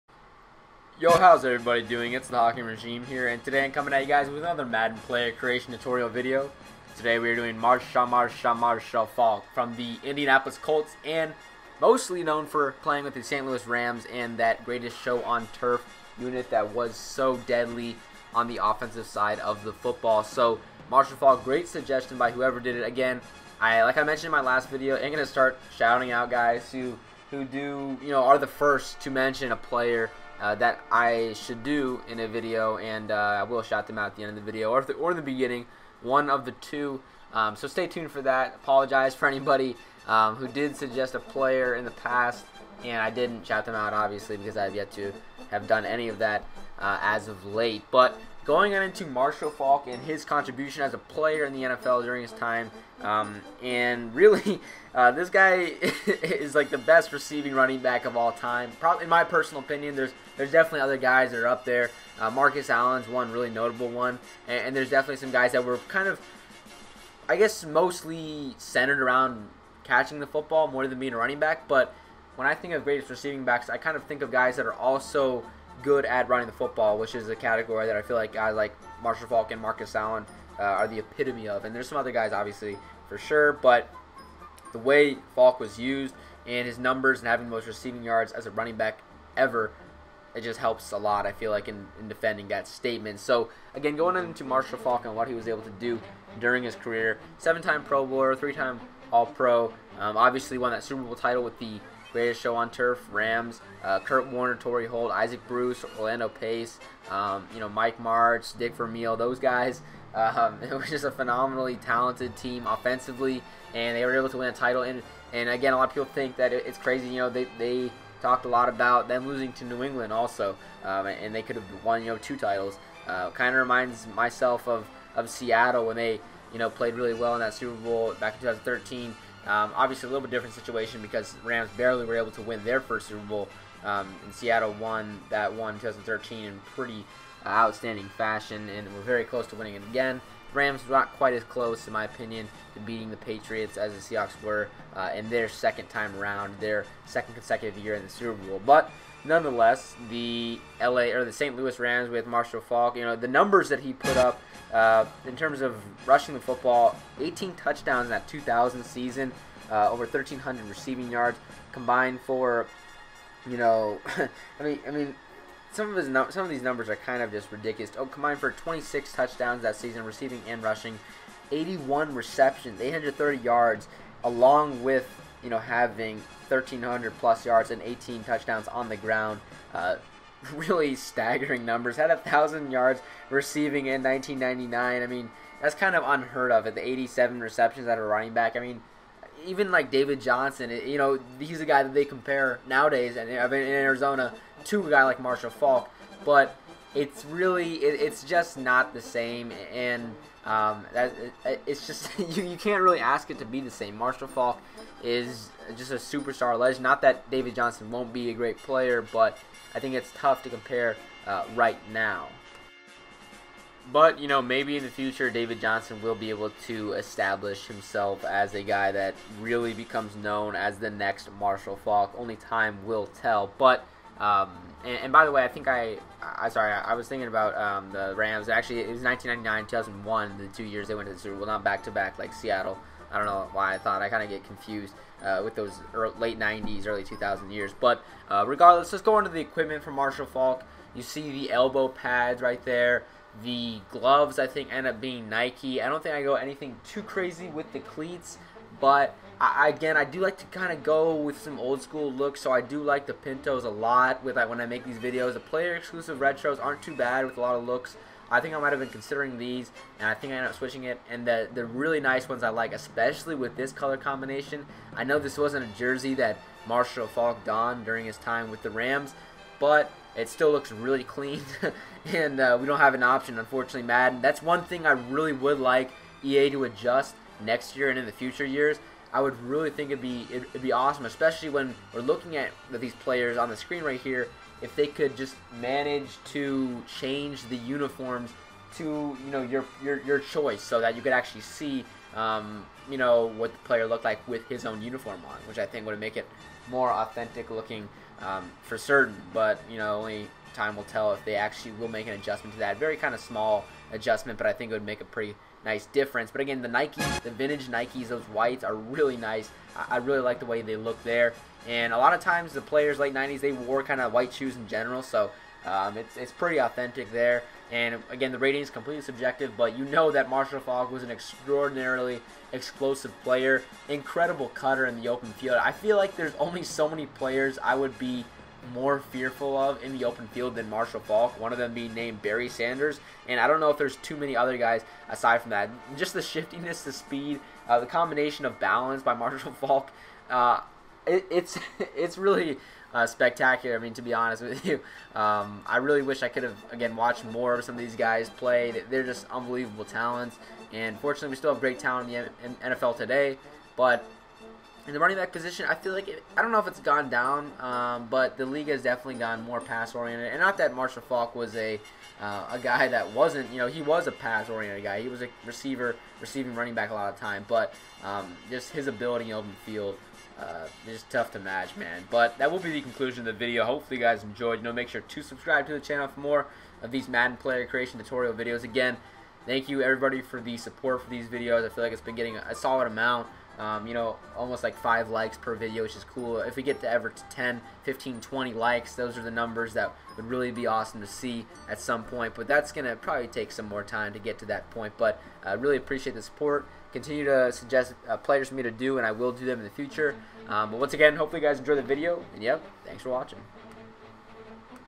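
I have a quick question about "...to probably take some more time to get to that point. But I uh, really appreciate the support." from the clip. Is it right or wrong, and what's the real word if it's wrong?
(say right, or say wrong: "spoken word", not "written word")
right.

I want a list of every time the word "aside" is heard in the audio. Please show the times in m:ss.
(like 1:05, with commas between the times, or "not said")
5:35.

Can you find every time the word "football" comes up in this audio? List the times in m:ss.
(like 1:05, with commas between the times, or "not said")
0:19, 1:10, 1:16, 2:36.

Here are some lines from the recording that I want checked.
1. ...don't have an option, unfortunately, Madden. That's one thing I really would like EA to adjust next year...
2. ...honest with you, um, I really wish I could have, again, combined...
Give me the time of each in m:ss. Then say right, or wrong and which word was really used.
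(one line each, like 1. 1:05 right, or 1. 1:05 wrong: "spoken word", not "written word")
1. 4:32 right
2. 5:44 wrong: "watched", not "combined".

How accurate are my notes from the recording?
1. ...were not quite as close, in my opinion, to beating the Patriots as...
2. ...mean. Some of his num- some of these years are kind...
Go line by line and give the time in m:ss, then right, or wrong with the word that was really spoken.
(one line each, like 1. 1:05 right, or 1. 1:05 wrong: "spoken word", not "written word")
1. 2:20 right
2. 2:44 wrong: "numbers", not "years".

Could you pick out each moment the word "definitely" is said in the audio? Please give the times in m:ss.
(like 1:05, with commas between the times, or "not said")
1:00, 1:04, 5:58.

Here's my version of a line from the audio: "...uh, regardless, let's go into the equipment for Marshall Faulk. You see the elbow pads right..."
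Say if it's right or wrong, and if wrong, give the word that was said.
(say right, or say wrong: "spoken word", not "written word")
right.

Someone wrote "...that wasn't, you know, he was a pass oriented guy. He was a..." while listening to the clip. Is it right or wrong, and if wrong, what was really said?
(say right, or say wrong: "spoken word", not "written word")
right.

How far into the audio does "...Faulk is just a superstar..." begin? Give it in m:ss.
3:24.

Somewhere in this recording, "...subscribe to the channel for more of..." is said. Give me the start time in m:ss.
6:15.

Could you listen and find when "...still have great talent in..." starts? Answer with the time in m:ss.
5:51.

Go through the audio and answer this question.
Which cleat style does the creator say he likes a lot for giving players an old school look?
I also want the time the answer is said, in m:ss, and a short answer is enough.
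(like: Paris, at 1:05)
Pintos, at 4:13.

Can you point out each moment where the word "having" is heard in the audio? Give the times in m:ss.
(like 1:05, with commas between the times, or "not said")
1:27, 2:55.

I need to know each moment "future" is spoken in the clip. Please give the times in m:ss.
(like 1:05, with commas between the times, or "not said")
3:34, 4:38, 6:39.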